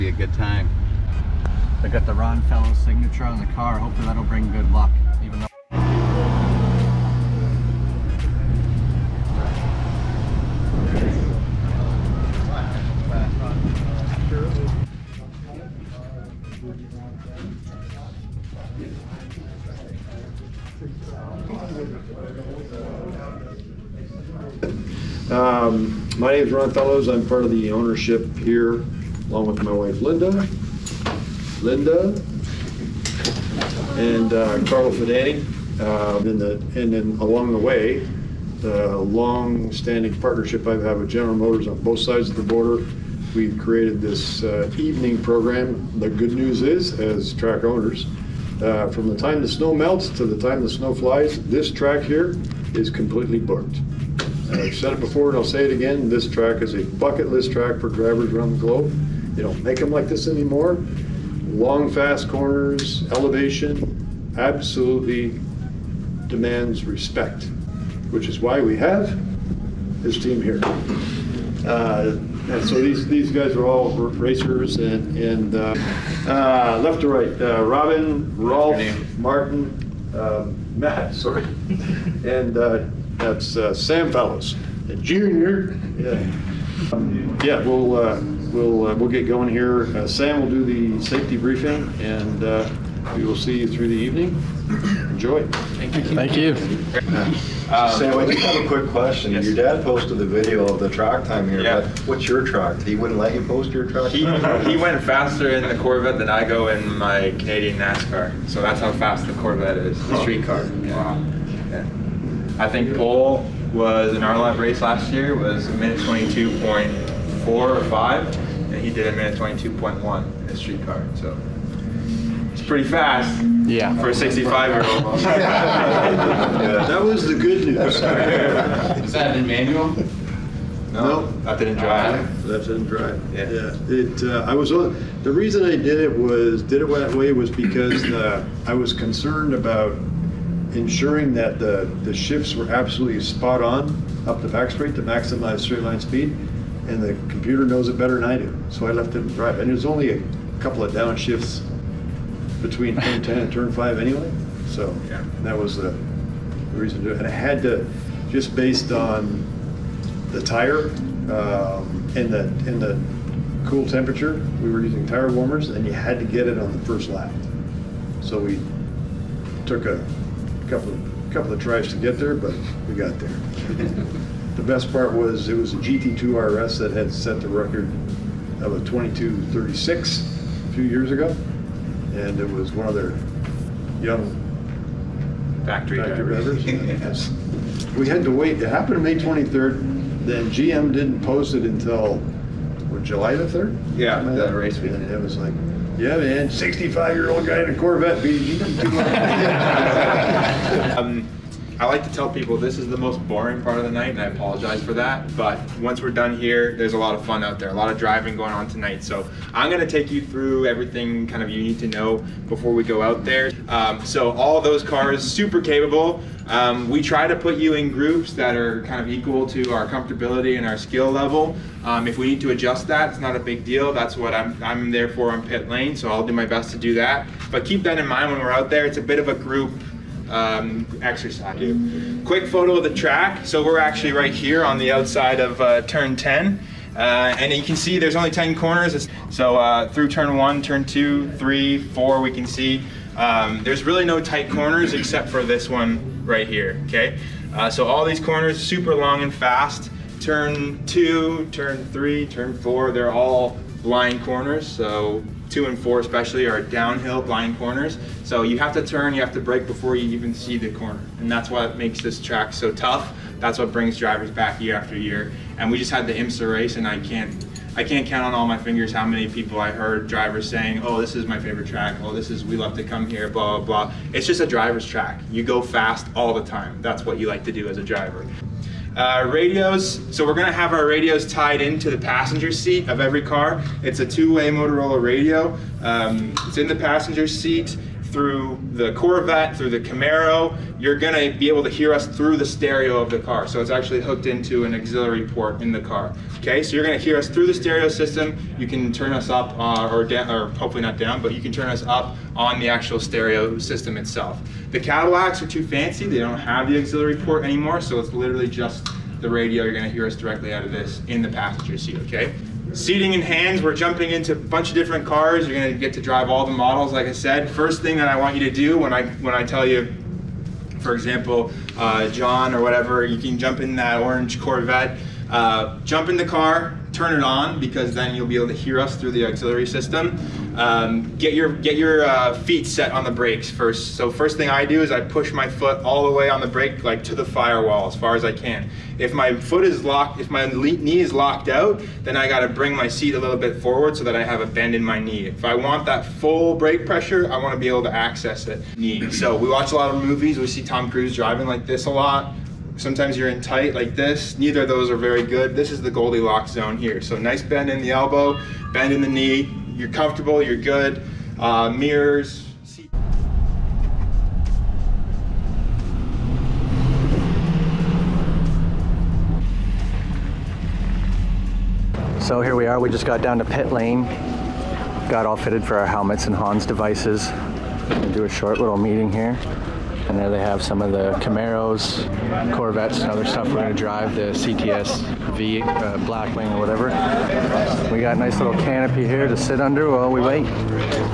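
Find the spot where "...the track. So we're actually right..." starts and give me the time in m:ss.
3:52.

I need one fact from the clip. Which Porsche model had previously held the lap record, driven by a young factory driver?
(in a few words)
GT2 RS.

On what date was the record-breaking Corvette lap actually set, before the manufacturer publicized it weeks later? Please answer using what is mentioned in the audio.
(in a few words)
May 23.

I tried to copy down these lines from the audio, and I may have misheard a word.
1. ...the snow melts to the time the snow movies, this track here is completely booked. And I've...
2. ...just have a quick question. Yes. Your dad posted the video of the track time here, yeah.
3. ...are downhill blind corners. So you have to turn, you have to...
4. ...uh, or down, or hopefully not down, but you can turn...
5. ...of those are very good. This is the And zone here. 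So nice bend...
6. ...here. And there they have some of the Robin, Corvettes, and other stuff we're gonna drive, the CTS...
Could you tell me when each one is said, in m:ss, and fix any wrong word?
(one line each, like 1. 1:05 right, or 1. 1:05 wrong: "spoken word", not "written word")
1. 0:49 wrong: "flies", not "movies"
2. 1:38 right
3. 4:16 right
4. 4:59 right
5. 5:54 wrong: "Goldilocks", not "And"
6. 6:19 wrong: "Camaros", not "Robin".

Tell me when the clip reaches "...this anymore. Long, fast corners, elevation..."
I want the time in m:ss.
1:00.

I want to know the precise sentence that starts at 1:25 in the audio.
Yeah, um, yeah we'll, we'll, we'll get going here.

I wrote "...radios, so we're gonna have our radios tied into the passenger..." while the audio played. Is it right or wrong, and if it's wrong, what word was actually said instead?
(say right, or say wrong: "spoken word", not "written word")
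right.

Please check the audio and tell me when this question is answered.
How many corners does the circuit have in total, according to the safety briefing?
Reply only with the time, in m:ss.
3:58.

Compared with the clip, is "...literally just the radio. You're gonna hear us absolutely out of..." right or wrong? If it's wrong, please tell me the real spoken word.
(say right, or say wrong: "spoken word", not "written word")
wrong: "directly", not "absolutely".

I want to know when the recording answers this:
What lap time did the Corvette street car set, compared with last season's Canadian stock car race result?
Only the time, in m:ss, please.
1:59.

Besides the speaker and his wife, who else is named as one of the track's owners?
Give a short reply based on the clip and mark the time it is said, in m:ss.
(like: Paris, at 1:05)
Carlo Fidani, at 0:34.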